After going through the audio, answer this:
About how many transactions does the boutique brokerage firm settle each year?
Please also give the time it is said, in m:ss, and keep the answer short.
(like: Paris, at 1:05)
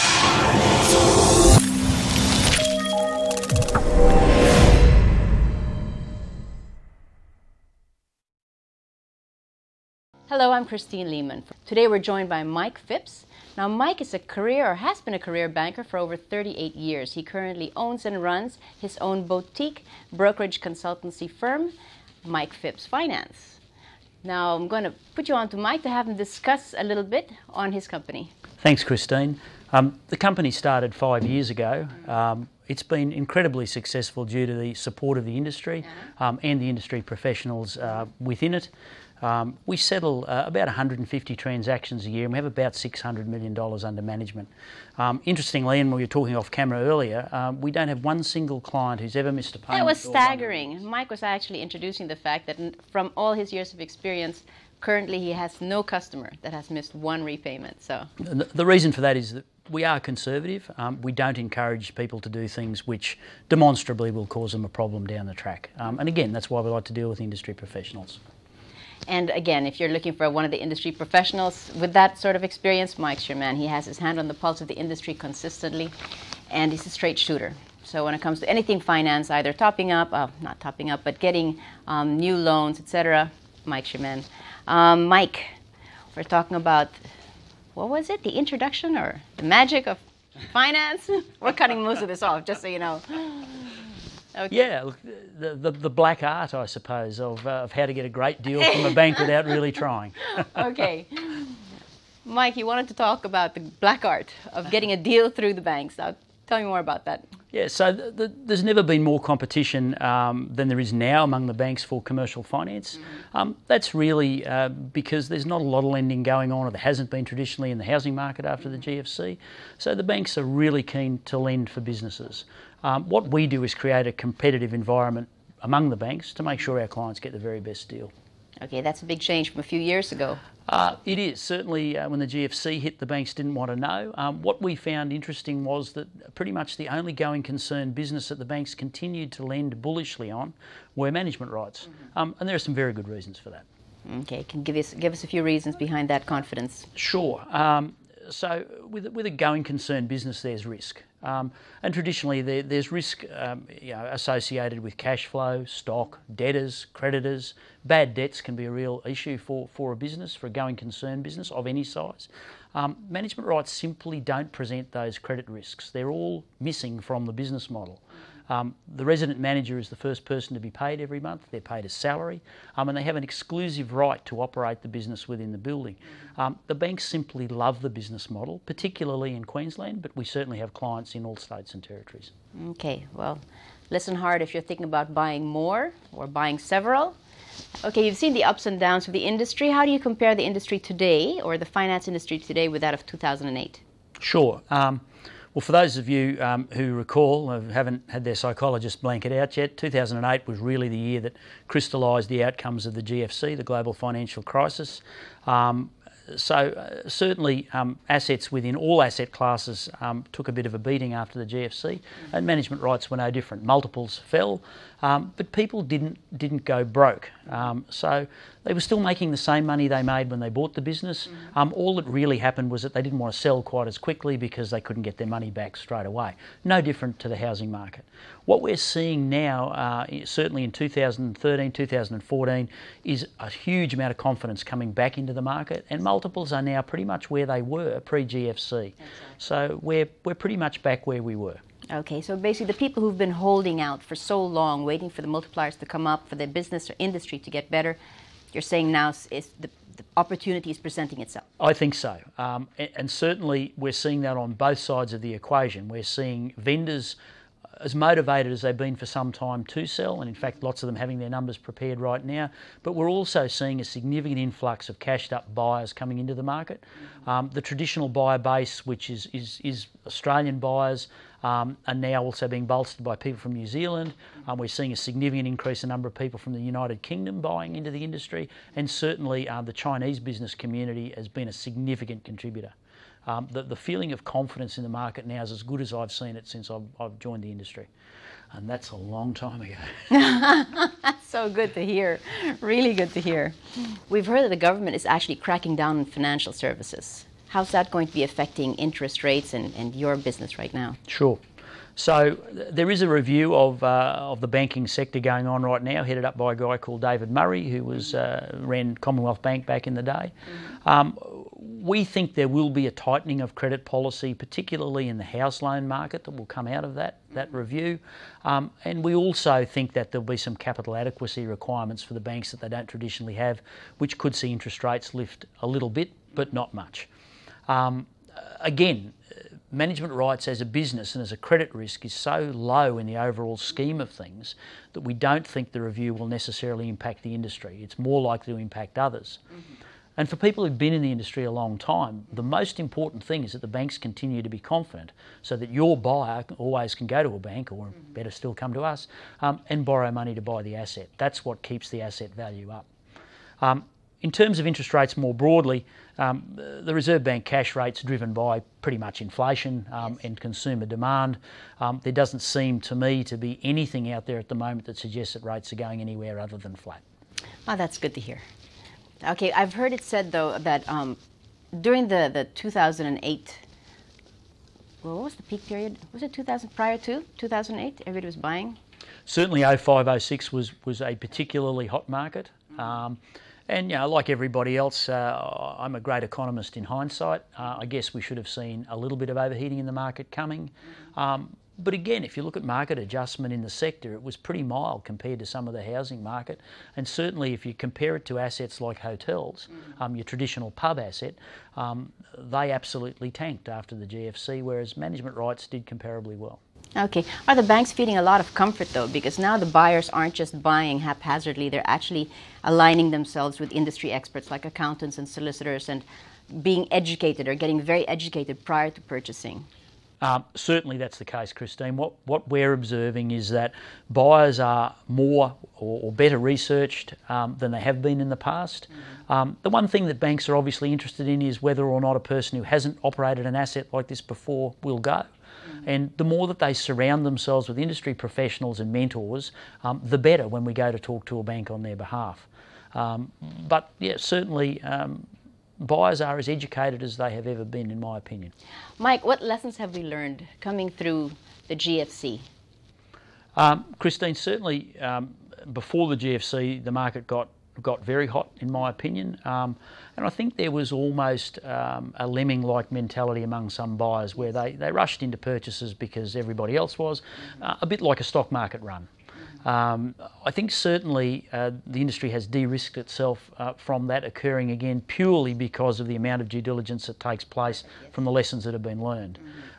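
150, at 0:40.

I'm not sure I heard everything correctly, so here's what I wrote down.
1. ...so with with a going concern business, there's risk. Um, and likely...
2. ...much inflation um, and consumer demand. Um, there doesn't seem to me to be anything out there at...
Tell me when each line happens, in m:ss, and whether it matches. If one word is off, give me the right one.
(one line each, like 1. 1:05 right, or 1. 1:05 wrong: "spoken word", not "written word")
1. 2:28 wrong: "traditionally", not "likely"
2. 5:58 right.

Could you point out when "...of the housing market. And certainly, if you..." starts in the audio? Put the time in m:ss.
6:35.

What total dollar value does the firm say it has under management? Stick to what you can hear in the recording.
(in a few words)
$600 million.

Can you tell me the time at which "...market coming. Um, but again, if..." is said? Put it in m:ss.
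6:29.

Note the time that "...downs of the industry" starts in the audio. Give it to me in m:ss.
3:08.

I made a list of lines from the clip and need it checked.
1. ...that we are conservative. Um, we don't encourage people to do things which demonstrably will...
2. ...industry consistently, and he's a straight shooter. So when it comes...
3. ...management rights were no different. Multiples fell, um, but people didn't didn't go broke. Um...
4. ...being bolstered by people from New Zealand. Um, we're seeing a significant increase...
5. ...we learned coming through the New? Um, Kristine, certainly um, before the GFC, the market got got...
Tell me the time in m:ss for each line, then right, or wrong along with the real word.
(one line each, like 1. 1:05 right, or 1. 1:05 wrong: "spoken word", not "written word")
1. 0:59 right
2. 1:14 right
3. 3:32 right
4. 4:32 right
5. 7:29 wrong: "GFC", not "New".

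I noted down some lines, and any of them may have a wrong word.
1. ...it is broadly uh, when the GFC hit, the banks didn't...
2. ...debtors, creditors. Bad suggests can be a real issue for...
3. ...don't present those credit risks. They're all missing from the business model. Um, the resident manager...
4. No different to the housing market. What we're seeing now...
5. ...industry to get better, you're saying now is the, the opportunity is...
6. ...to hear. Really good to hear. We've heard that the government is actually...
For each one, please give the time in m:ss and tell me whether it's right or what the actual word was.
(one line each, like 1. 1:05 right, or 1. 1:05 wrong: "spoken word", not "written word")
1. 2:11 wrong: "certainly", not "broadly"
2. 2:36 wrong: "debts", not "suggests"
3. 2:44 right
4. 3:46 right
5. 4:06 right
6. 4:51 right.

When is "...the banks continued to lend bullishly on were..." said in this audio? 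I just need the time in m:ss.
2:18.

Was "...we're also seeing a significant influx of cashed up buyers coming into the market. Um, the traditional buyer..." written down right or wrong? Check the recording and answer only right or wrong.
right.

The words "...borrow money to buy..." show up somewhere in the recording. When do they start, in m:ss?
5:49.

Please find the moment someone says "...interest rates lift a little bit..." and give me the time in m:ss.
5:24.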